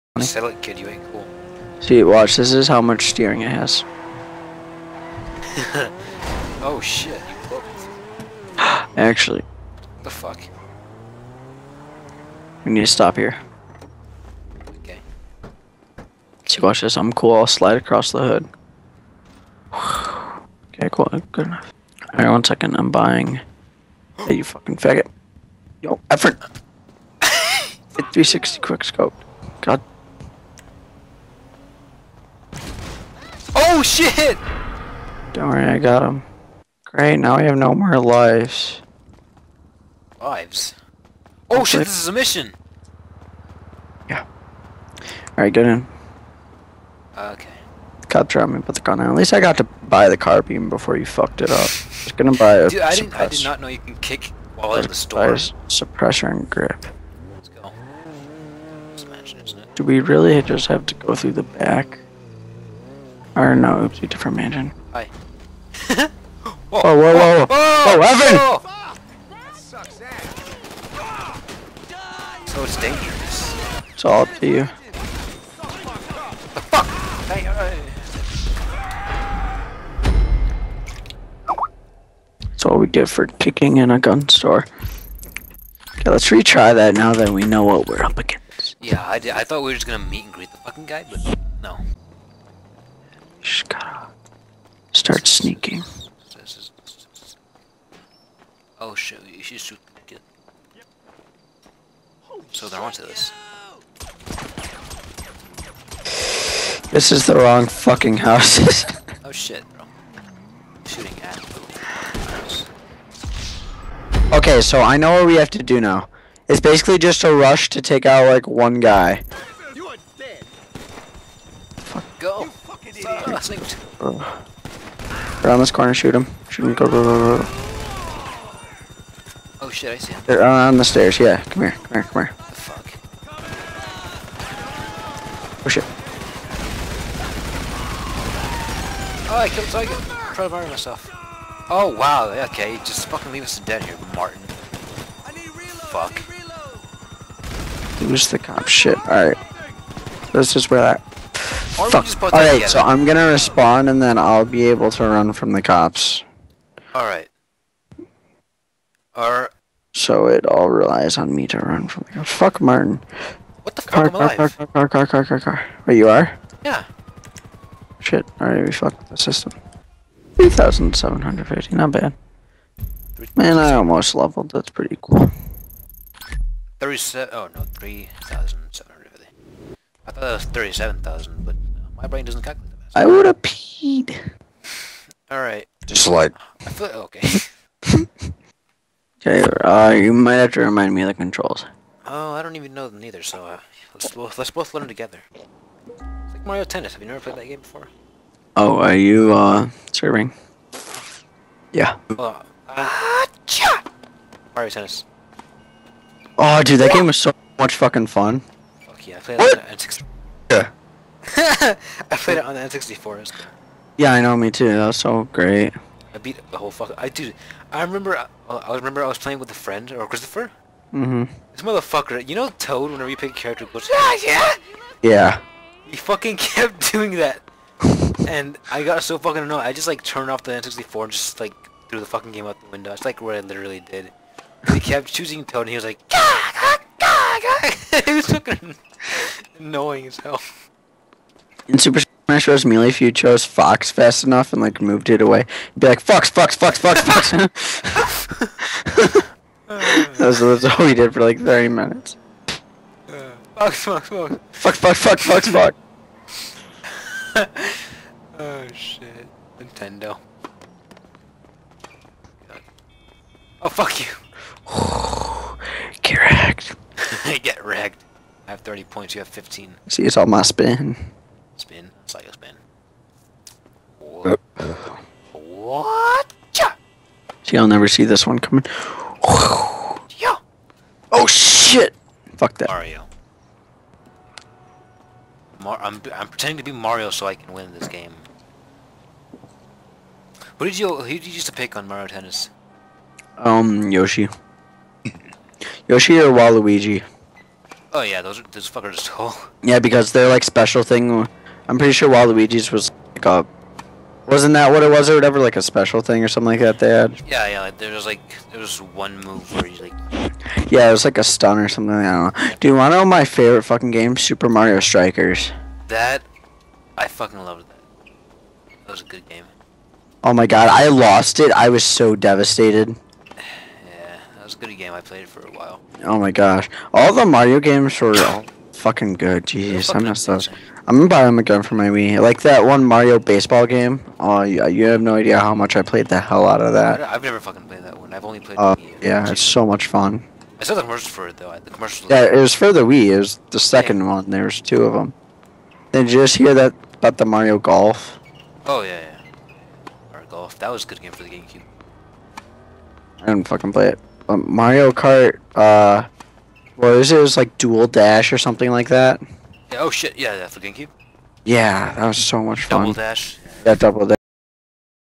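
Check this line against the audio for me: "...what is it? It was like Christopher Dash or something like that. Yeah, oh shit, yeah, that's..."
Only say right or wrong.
wrong.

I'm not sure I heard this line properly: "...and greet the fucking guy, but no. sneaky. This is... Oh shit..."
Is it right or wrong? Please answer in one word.
right.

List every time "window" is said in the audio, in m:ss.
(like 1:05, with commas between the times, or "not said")
3:52.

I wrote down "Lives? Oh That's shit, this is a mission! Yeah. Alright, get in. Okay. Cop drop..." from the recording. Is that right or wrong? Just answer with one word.
right.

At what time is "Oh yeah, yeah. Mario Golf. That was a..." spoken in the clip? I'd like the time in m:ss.
5:48.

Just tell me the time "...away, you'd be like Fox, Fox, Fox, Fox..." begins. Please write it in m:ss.
4:05.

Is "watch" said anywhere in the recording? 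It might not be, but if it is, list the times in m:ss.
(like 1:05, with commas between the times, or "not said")
0:02, 0:16.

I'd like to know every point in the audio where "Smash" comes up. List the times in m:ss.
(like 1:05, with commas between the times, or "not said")
4:02.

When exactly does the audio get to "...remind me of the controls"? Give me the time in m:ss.
3:10.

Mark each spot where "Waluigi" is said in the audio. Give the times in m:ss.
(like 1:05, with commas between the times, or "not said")
4:56, 5:02.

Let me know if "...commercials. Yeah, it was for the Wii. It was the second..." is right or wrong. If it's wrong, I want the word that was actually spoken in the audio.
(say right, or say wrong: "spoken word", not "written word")
right.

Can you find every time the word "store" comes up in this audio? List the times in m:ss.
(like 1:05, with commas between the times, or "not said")
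0:54, 1:24.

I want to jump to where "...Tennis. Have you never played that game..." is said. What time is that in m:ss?
3:16.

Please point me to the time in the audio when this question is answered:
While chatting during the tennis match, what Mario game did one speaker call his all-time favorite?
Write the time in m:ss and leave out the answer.
5:14.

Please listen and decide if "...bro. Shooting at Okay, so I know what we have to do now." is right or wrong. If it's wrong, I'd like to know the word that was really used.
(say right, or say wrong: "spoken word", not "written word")
right.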